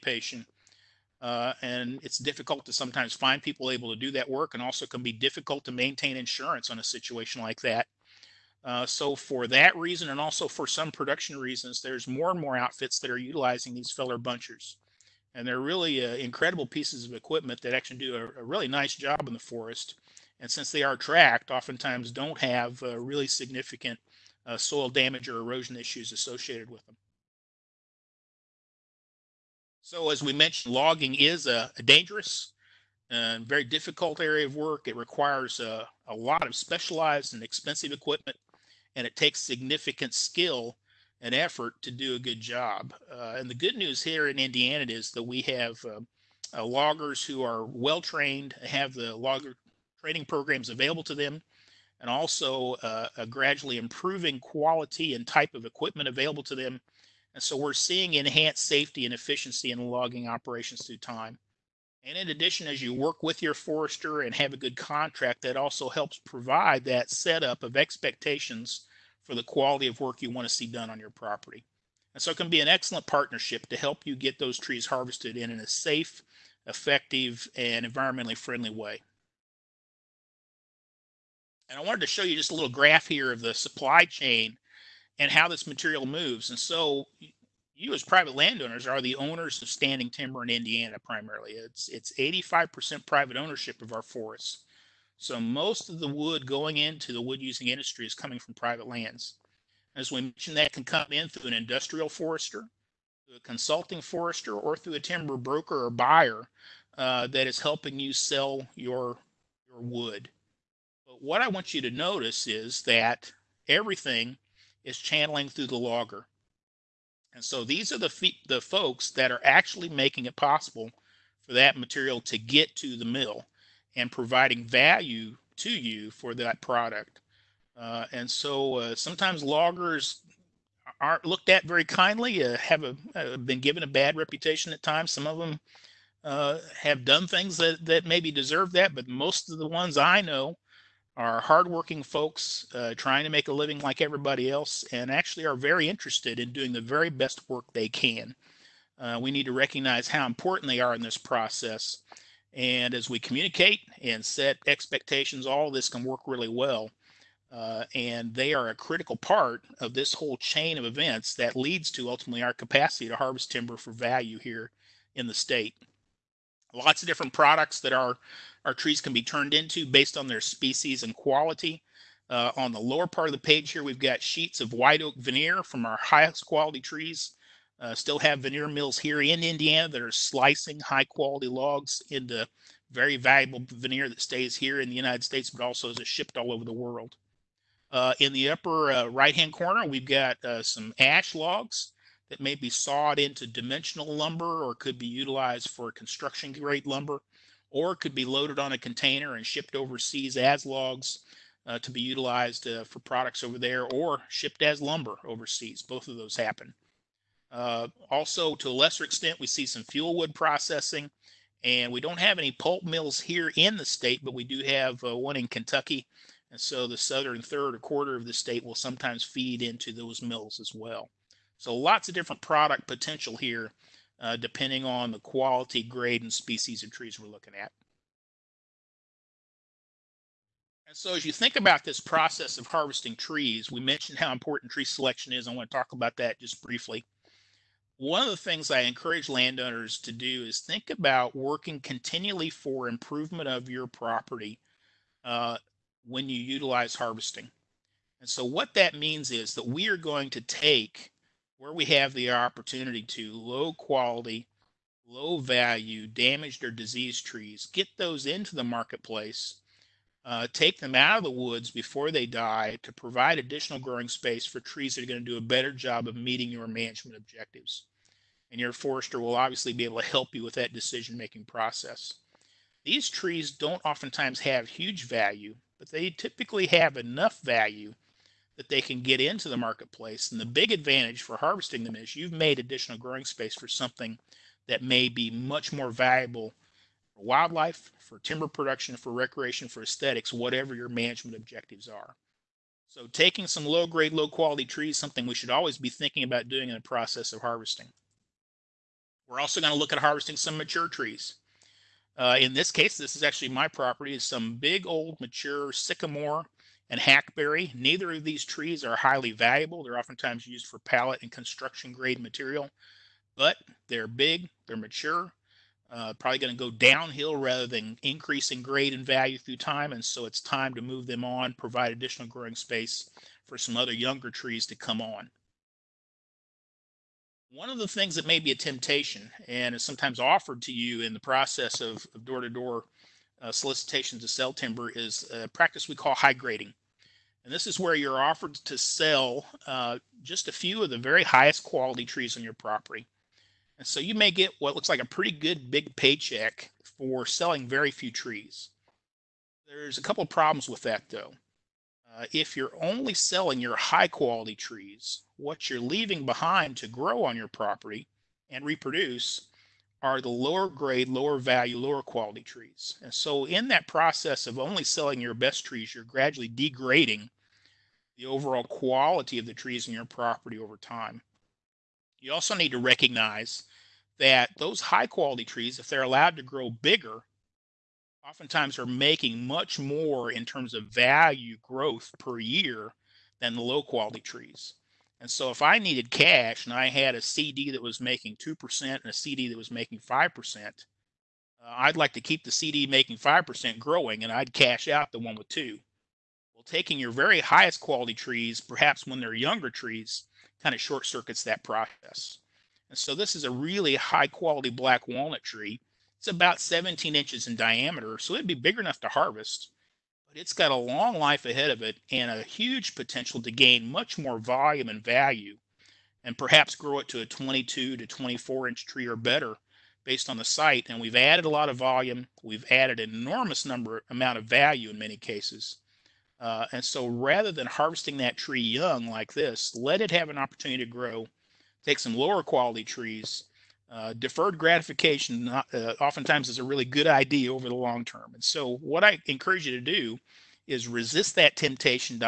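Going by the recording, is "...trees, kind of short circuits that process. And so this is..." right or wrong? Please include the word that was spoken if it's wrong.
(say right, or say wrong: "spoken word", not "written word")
right.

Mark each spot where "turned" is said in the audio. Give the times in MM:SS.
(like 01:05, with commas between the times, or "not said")
02:49.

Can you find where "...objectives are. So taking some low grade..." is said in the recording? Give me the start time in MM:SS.
04:51.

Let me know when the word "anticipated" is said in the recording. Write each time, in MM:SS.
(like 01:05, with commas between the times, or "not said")
not said.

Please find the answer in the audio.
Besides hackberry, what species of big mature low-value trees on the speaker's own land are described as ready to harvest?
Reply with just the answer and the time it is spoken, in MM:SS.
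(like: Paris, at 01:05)
sycamore, at 05:05.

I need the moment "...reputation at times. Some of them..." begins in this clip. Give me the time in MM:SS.
02:14.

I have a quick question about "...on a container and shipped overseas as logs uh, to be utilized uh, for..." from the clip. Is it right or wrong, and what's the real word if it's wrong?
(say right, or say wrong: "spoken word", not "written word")
right.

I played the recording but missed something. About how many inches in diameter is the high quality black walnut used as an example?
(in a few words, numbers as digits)
17.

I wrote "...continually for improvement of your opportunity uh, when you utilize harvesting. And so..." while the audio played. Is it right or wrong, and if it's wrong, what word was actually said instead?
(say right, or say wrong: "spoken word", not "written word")
wrong: "property", not "opportunity".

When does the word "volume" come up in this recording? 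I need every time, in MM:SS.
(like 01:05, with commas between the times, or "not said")
06:54, 07:01.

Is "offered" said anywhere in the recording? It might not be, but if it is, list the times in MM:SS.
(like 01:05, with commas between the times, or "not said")
05:30, 05:38.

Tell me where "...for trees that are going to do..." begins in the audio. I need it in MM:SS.
04:24.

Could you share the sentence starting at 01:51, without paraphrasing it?
But what I want you to notice is that everything is channeling through the logger.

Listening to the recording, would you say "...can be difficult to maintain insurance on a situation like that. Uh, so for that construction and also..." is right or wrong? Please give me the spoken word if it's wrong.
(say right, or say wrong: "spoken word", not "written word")
wrong: "reason", not "construction".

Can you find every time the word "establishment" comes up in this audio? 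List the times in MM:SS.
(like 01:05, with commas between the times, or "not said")
not said.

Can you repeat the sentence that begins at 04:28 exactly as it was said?
And your forester will obviously be able to help you with that decision making process.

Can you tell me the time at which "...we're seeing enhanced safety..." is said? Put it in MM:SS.
00:57.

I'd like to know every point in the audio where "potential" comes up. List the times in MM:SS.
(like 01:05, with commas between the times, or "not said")
03:42, 06:52.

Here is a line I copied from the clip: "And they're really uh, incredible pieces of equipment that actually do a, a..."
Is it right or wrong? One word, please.
right.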